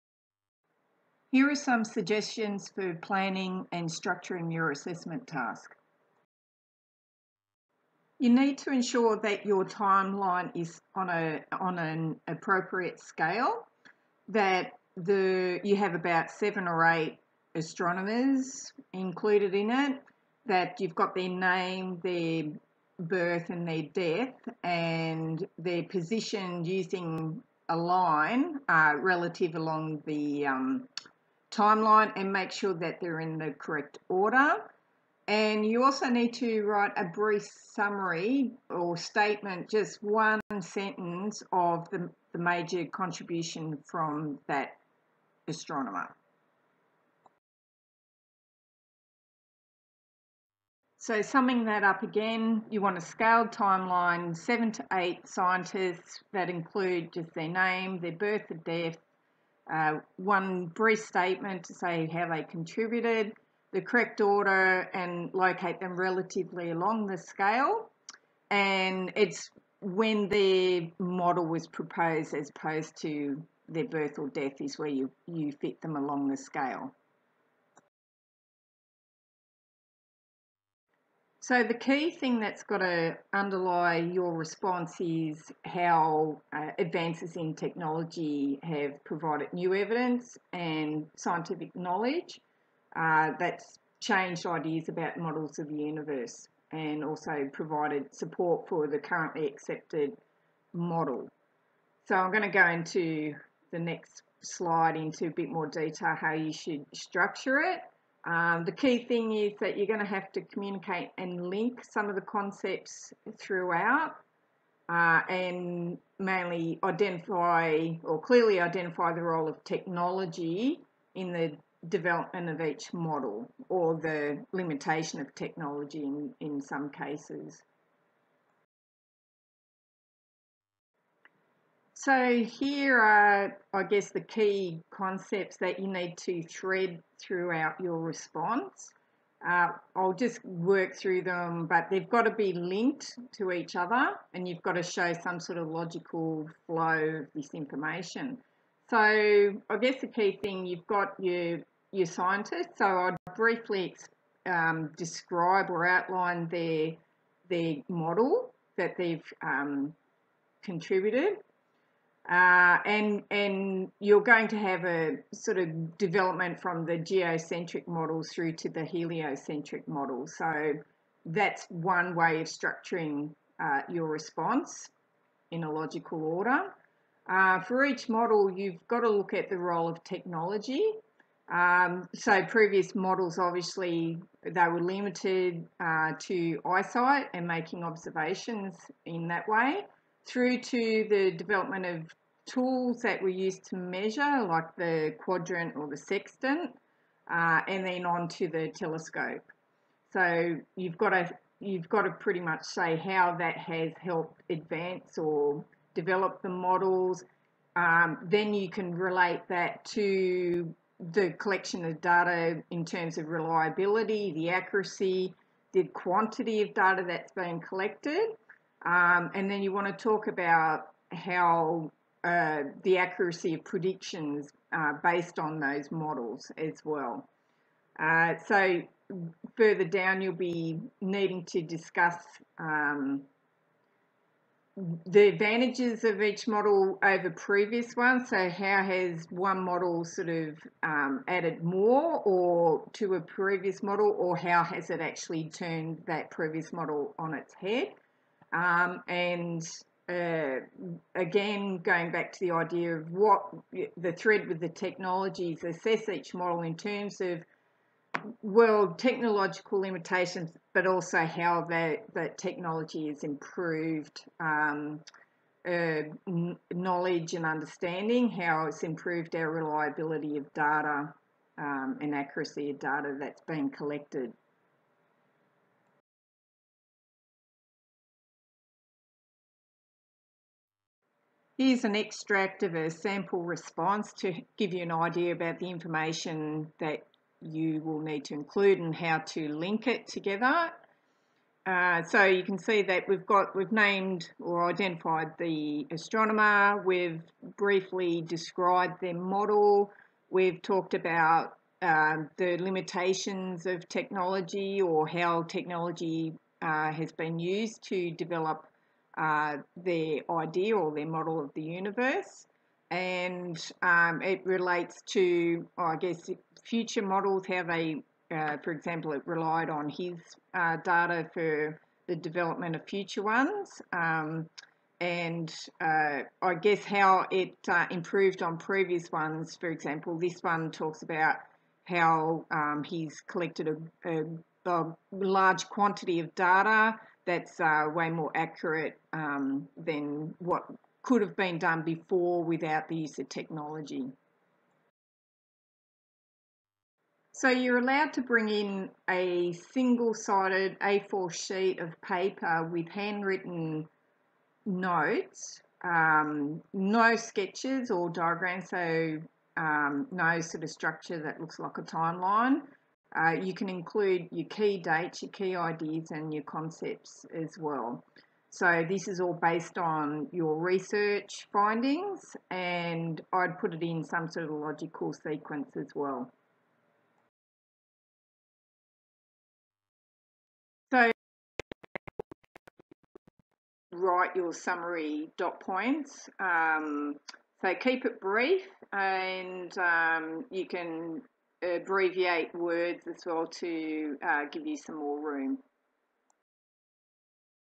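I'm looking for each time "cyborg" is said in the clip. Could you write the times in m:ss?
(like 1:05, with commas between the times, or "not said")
not said.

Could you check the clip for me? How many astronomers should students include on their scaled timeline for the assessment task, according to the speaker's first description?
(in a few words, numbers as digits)
7 or 8.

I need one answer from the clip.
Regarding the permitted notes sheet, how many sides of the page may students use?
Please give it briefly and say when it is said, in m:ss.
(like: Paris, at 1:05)
Single-sided, at 5:49.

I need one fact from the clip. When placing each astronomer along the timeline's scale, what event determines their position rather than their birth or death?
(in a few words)
When their model was proposed.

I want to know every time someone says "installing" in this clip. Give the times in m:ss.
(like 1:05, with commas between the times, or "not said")
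not said.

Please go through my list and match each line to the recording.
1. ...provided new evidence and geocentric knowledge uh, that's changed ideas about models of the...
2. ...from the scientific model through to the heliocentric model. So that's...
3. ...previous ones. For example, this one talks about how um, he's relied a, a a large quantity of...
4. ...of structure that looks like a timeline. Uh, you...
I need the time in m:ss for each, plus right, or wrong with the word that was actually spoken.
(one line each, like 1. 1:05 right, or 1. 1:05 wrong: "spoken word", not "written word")
1. 1:29 wrong: "scientific", not "geocentric"
2. 2:46 wrong: "geocentric", not "scientific"
3. 5:28 wrong: "collected", not "relied"
4. 6:00 right.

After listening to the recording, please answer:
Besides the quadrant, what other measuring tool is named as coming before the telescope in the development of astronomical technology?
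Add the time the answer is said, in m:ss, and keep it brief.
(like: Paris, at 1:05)
Sextant, at 3:15.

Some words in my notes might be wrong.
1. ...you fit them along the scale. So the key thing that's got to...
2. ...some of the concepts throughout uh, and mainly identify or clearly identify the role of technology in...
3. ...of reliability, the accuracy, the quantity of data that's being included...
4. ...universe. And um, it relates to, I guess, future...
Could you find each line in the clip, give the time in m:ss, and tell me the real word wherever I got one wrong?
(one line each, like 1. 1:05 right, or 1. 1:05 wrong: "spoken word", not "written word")
1. 1:15 right
2. 1:51 right
3. 3:33 wrong: "collected", not "included"
4. 5:11 right.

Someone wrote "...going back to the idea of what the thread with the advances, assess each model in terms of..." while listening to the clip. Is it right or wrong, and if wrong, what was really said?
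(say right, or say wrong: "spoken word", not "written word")
wrong: "technologies", not "advances".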